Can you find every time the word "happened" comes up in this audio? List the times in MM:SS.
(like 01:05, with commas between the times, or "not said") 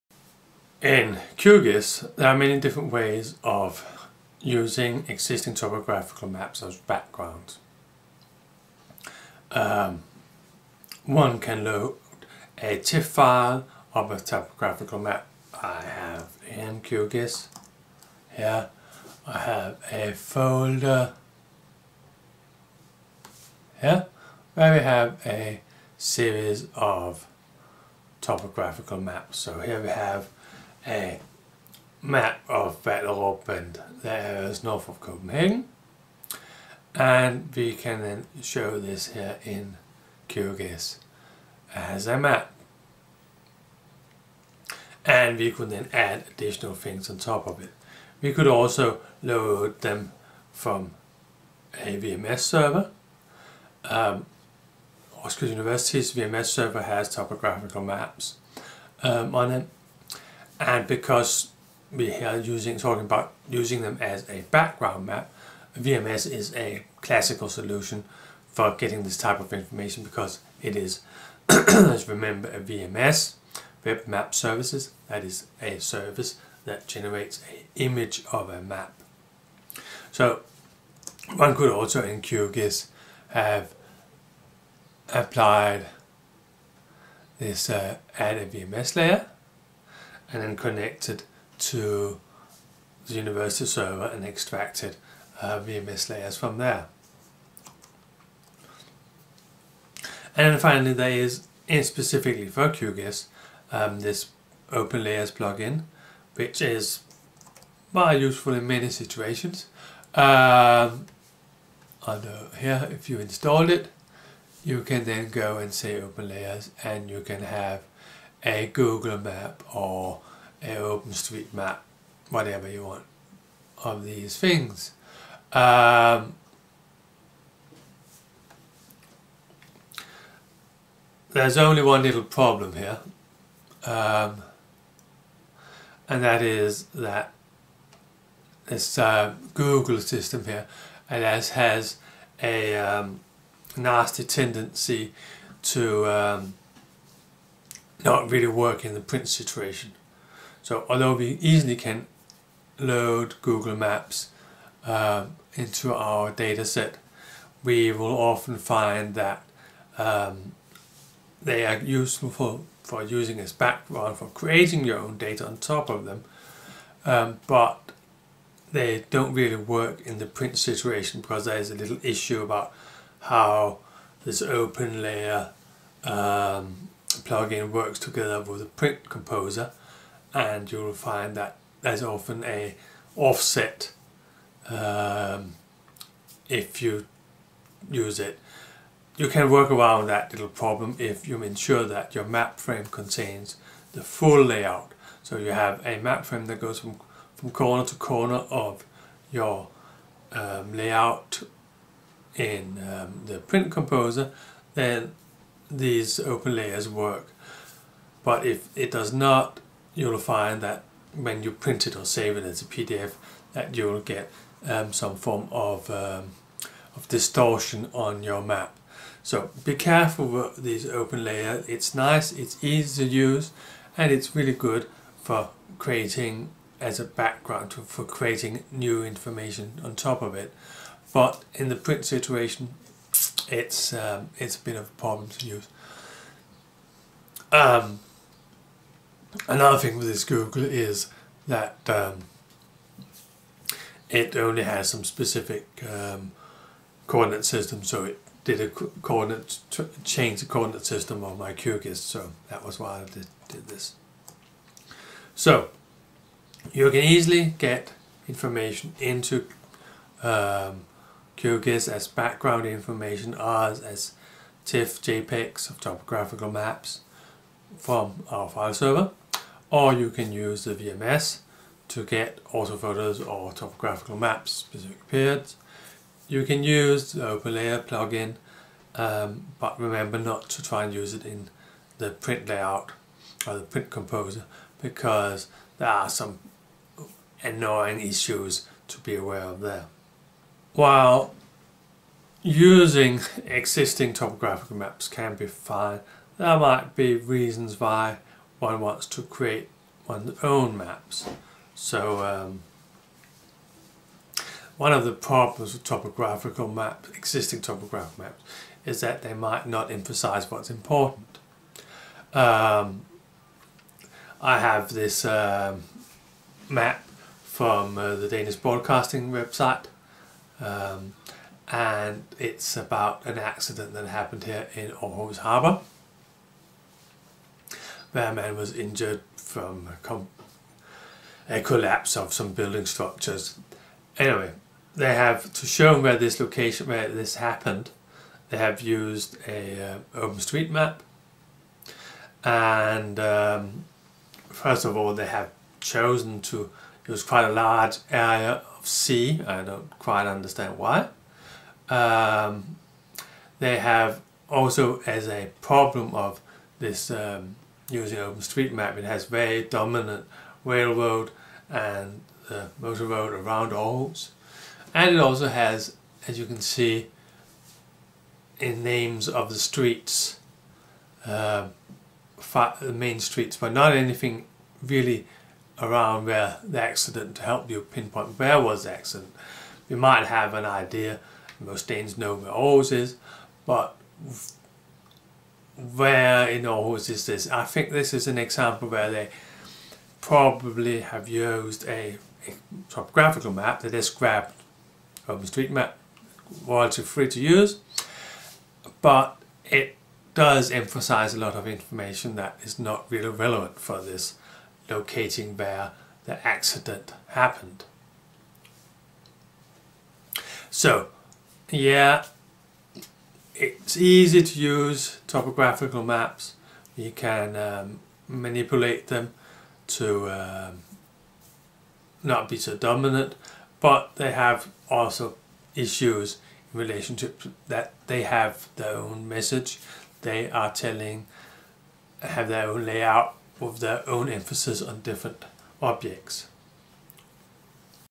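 05:24, 05:37, 06:47.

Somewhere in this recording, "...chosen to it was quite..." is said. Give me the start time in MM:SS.
05:45.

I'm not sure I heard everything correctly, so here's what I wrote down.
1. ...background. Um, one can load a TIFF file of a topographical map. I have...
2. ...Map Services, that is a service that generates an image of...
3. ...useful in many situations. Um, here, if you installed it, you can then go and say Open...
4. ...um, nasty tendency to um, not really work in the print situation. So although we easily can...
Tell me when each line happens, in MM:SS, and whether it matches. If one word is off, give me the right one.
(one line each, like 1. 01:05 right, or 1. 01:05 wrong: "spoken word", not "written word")
1. 00:06 right
2. 01:14 right
3. 01:48 right
4. 02:22 right.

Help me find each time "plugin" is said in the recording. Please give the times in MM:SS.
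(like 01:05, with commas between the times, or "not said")
01:45, 02:57, 04:37.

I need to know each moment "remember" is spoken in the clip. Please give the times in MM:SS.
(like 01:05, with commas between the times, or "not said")
01:12, 04:39.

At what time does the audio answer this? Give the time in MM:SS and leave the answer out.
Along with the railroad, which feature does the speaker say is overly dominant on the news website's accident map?
06:02.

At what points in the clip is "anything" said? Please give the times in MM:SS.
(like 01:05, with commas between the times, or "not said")
06:13.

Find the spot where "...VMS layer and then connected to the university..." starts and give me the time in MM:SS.
01:28.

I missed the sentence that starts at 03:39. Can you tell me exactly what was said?
So be careful with these open layer.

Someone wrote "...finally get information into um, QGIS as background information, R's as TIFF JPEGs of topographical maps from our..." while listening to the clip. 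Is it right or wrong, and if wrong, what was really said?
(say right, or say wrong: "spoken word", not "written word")
wrong: "easily", not "finally".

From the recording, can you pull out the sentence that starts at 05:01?
So um, one of the problems with topographical maps, existing topographical maps, is that they might not emphasize what's important.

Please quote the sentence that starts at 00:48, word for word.
We could also load them from a VMS server.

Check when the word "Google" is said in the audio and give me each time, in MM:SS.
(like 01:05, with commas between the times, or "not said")
01:58, 02:19, 02:33, 04:00.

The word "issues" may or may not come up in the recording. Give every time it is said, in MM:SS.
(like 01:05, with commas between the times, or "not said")
02:52, 04:47, 07:05.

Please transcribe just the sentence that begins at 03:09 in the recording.
You can work around that little problem if you ensure that your map frame contains the full layout.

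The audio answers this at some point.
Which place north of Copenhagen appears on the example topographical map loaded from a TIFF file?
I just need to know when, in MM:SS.
00:32.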